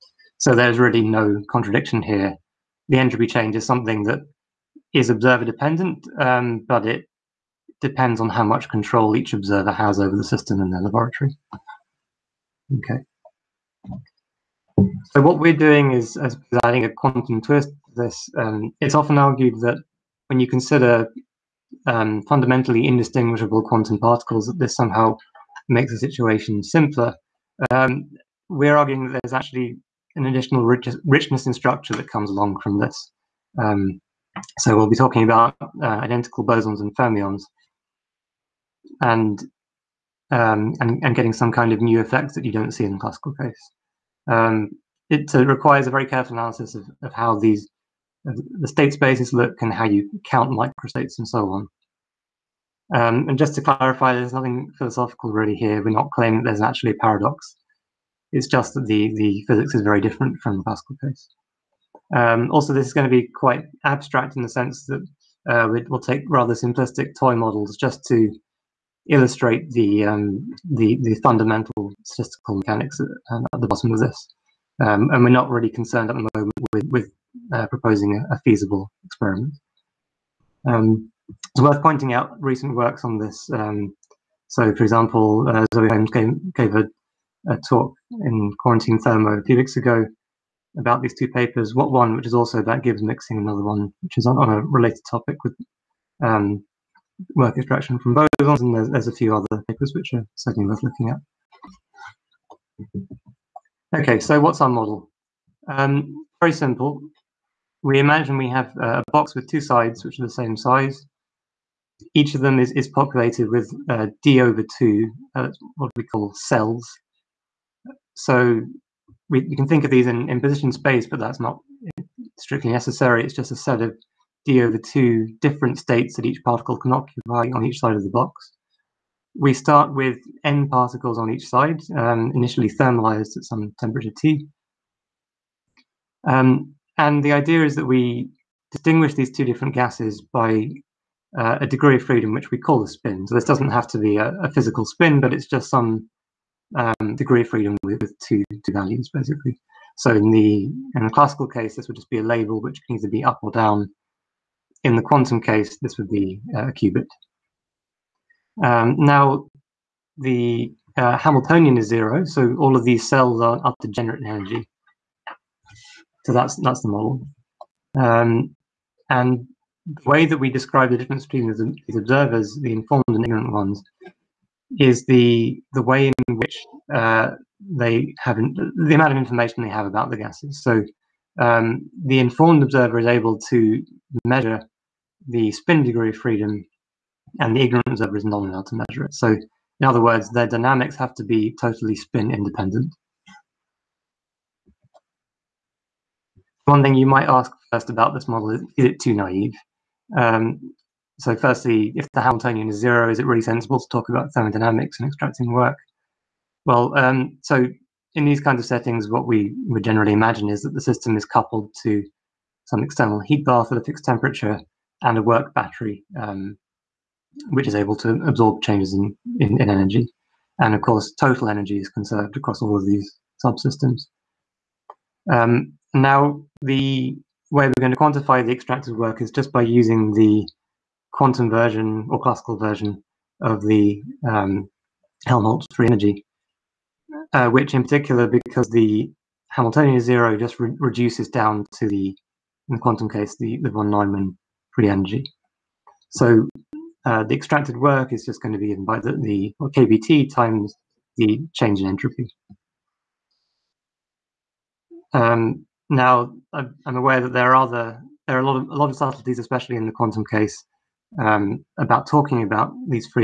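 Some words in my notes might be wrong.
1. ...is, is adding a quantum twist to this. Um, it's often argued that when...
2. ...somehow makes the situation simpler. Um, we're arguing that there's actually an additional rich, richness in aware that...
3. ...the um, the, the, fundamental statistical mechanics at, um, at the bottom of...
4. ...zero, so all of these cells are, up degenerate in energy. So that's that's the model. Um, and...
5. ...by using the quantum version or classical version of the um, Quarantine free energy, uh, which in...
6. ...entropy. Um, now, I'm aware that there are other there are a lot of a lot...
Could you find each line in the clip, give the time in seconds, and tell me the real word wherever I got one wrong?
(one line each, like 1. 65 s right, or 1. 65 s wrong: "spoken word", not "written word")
1. 15 s right
2. 24 s wrong: "structure", not "aware"
3. 69 s right
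4. 161 s right
5. 229 s wrong: "Helmholtz", not "Quarantine"
6. 251 s right.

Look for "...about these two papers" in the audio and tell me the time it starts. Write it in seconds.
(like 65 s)
90 s.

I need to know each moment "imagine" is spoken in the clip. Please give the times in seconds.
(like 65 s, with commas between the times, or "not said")
107 s, 210 s.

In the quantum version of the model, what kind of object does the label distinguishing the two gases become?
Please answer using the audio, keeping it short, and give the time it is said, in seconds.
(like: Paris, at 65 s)
a qubit, at 156 s.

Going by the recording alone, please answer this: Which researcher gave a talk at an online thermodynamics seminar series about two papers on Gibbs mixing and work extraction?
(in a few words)
Zoe Holmes.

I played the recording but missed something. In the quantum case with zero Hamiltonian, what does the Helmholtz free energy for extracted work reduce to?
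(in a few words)
von Neumann free energy.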